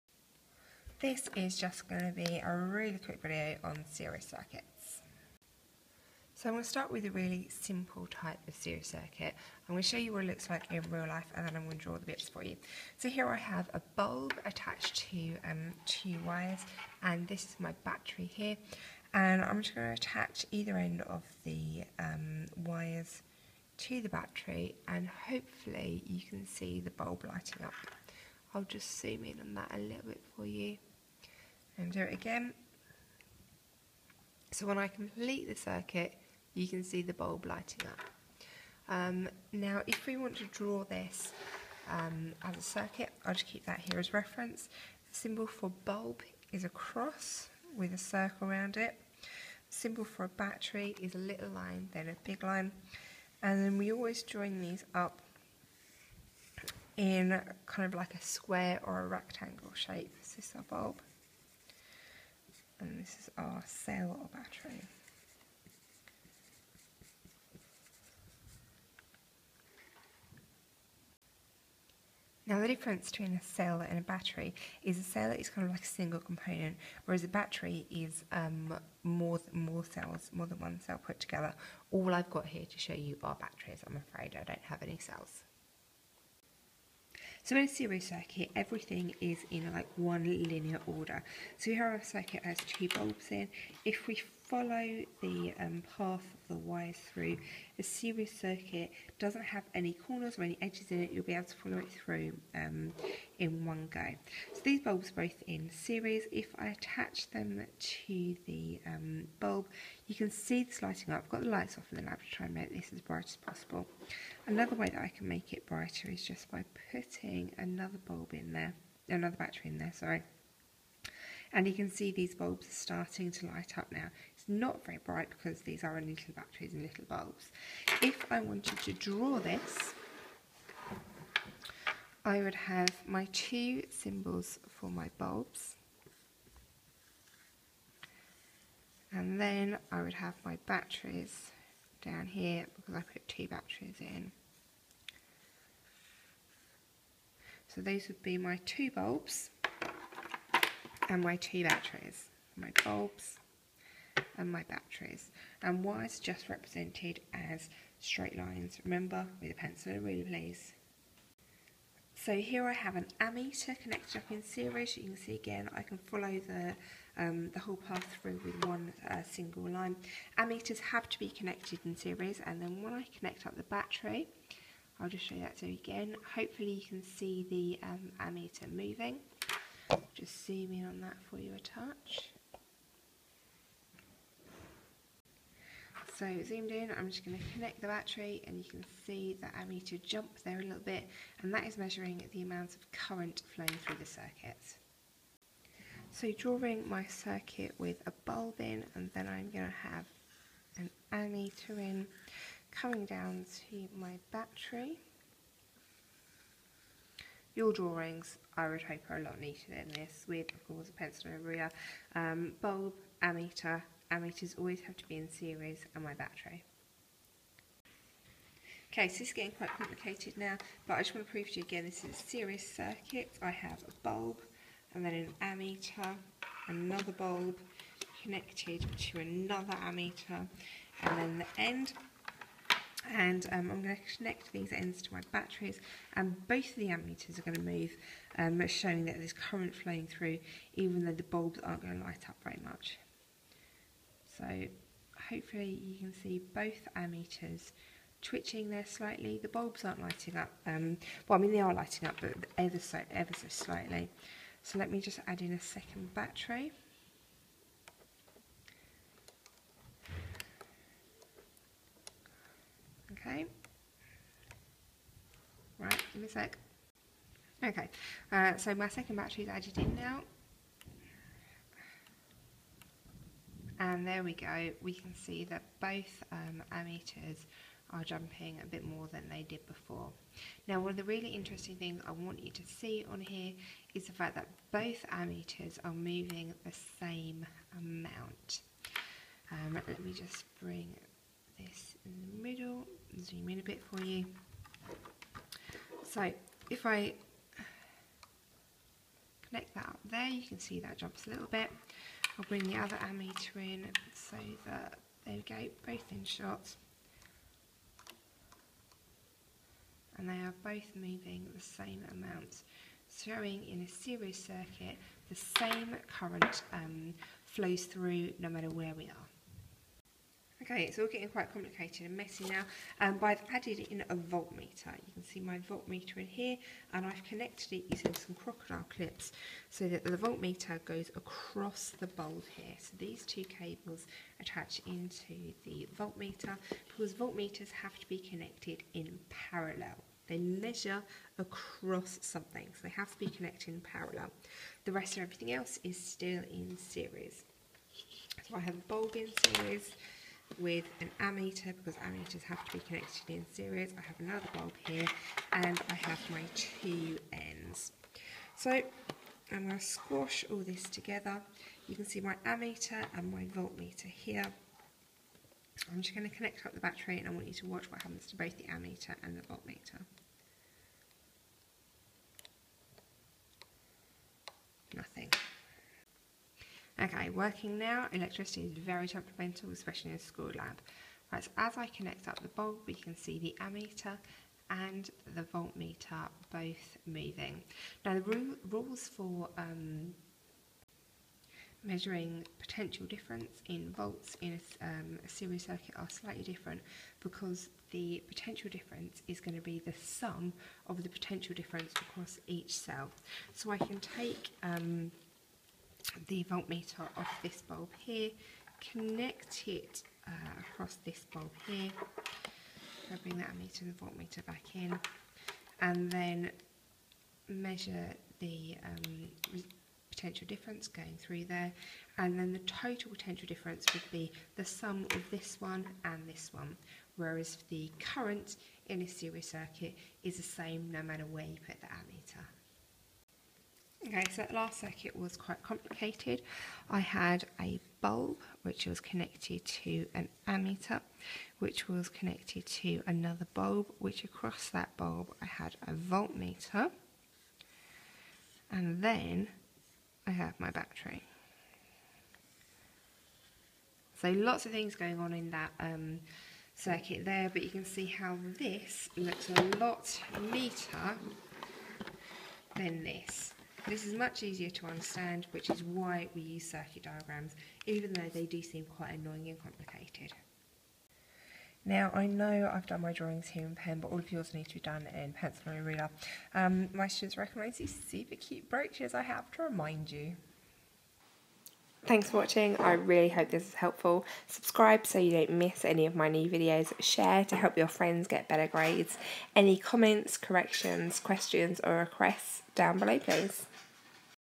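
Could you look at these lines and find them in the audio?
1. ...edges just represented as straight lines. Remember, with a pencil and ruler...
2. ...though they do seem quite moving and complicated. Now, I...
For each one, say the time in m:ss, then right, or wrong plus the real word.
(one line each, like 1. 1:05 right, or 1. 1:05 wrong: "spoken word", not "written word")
1. 2:35 wrong: "wires", not "edges"
2. 7:48 wrong: "annoying", not "moving".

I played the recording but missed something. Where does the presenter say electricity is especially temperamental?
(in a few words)
a school lab.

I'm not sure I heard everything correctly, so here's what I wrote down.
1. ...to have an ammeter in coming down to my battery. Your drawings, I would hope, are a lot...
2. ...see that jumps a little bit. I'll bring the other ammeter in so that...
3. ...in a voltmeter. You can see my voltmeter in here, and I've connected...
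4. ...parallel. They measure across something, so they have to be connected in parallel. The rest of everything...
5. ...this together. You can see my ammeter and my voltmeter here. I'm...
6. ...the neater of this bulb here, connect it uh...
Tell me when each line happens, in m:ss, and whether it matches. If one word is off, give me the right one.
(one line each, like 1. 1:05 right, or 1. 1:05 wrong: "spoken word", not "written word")
1. 3:19 right
2. 5:00 right
3. 5:23 right
4. 5:39 right
5. 6:00 right
6. 6:46 wrong: "voltmeter", not "neater".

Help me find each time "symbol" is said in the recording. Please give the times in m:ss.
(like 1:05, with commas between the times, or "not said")
0:45, 0:49, 2:13.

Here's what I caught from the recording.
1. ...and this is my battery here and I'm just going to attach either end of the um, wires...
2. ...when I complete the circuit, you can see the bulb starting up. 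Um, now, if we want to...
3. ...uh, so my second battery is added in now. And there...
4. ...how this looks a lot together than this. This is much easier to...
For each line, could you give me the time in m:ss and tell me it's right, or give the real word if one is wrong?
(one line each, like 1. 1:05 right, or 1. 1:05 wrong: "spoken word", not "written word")
1. 0:17 right
2. 0:34 wrong: "lighting", not "starting"
3. 4:28 right
4. 7:38 wrong: "neater", not "together".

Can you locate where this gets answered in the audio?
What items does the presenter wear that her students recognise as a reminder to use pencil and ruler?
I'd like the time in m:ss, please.
7:58.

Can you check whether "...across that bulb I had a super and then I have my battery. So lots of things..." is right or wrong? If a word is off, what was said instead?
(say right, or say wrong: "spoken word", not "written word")
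wrong: "voltmeter", not "super".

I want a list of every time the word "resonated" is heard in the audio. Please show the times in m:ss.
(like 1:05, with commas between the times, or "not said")
not said.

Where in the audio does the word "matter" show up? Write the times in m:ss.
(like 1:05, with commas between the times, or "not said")
5:18, 7:11.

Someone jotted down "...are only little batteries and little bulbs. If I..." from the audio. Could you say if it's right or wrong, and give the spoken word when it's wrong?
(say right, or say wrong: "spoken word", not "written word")
right.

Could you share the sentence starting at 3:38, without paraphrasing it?
Okay, so this is getting quite complicated now, but I just want to prove to you again, this is a series circuit.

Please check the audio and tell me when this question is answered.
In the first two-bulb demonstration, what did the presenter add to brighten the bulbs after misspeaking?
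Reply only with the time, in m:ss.
1:59.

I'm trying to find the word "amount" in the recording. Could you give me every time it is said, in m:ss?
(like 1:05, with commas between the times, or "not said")
3:12, 4:47, 5:12.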